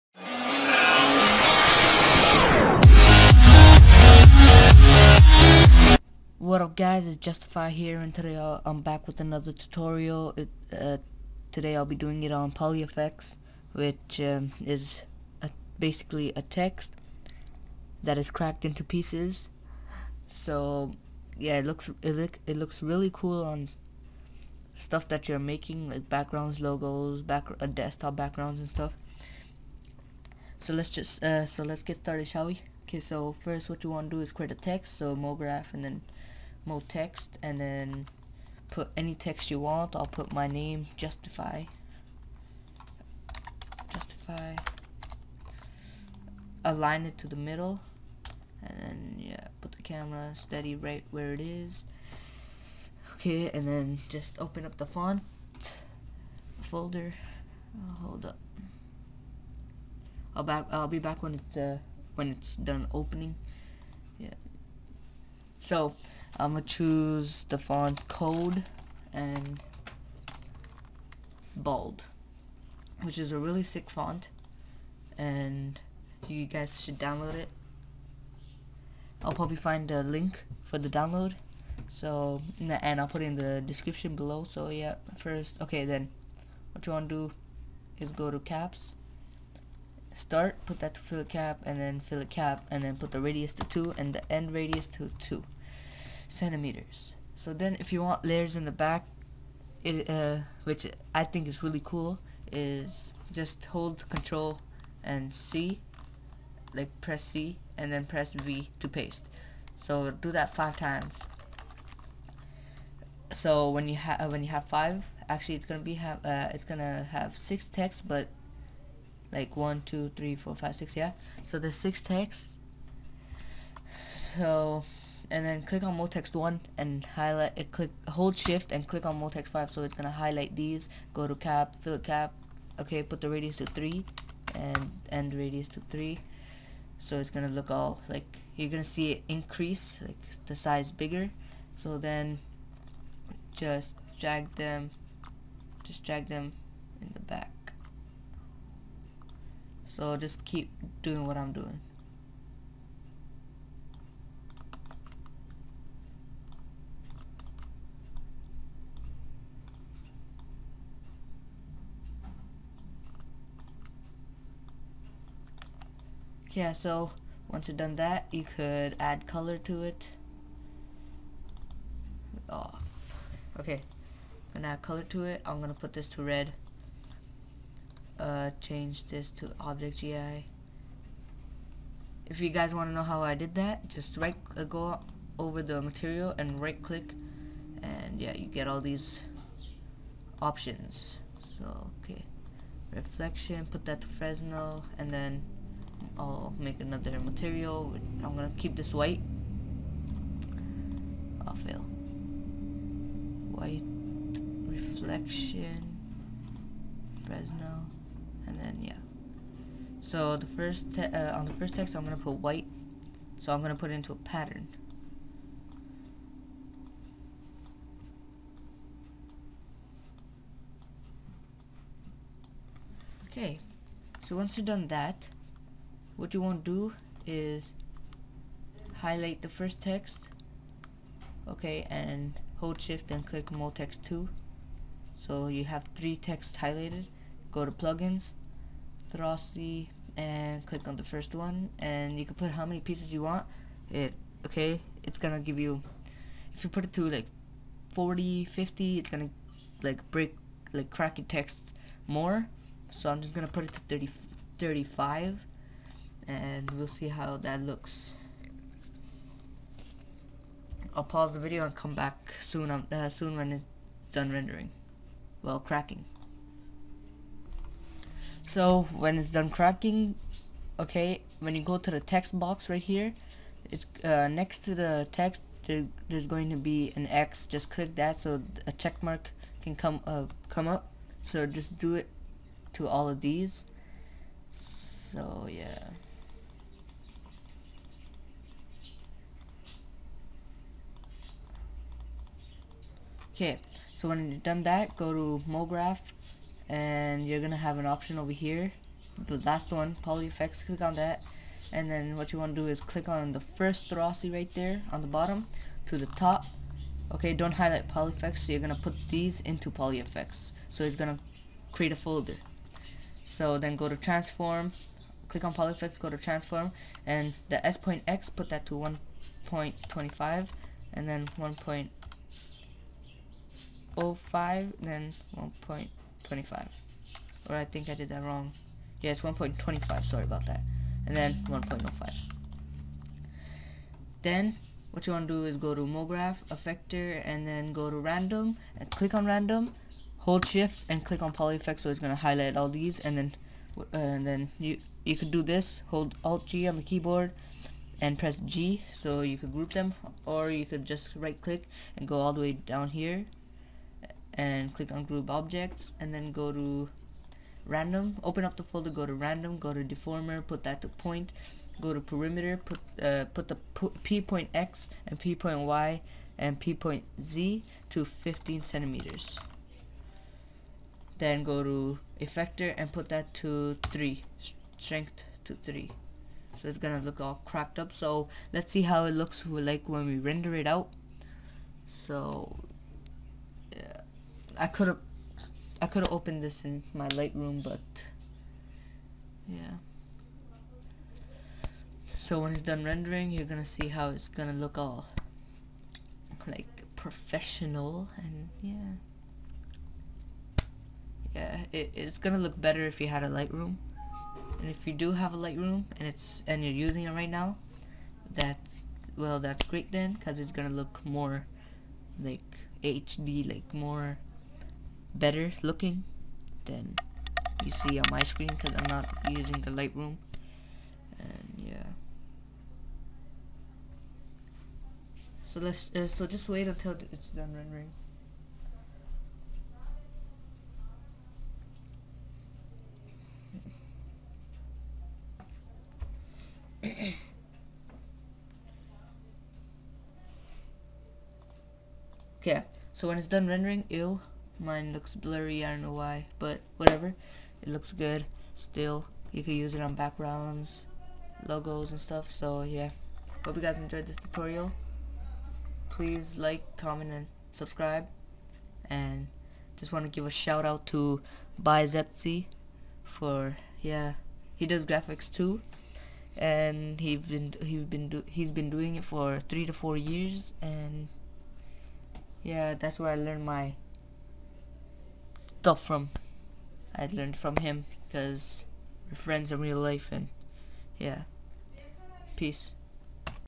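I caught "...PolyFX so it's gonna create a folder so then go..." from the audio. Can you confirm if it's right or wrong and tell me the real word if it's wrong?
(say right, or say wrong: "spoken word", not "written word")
right.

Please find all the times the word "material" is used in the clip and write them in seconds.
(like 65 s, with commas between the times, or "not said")
185 s, 197 s.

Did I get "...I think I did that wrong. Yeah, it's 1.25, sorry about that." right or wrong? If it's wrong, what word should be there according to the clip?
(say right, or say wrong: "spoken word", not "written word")
right.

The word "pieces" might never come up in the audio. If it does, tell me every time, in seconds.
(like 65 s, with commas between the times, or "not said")
18 s, 242 s.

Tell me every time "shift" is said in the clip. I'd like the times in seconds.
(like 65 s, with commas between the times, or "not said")
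128 s, 232 s, 340 s.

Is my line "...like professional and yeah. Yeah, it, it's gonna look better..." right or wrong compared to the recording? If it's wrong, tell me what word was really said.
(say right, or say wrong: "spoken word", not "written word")
right.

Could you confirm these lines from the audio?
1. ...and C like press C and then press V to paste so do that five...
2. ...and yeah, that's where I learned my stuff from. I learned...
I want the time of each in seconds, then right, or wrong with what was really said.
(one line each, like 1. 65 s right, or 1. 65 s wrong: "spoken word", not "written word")
1. 105 s right
2. 470 s right.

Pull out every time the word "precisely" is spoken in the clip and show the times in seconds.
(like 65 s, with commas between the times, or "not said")
not said.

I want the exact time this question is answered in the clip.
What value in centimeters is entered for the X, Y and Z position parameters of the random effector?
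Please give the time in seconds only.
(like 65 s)
368 s.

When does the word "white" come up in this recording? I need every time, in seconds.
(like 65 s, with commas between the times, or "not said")
198 s, 203 s, 212 s.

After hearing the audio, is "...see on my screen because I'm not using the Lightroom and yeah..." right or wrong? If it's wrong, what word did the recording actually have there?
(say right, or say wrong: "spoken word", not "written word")
right.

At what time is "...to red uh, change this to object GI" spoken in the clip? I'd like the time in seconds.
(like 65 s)
176 s.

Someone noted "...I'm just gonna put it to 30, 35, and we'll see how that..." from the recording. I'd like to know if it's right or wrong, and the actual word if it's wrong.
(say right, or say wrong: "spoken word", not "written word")
right.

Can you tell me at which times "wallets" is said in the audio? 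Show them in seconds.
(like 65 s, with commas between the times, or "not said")
not said.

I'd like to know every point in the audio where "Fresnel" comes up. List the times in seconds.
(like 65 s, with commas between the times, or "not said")
194 s, 207 s.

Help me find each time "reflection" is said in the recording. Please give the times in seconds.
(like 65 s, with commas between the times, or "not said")
192 s, 204 s.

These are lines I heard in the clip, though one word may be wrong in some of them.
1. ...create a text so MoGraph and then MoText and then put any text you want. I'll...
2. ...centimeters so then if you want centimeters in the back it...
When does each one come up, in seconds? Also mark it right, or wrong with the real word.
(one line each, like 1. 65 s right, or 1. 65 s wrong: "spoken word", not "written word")
1. 34 s right
2. 96 s wrong: "layers", not "centimeters".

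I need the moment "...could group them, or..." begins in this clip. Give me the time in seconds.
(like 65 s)
349 s.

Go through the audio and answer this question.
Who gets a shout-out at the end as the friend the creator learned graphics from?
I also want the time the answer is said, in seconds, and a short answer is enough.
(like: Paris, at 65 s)
ByyZeptzy, at 461 s.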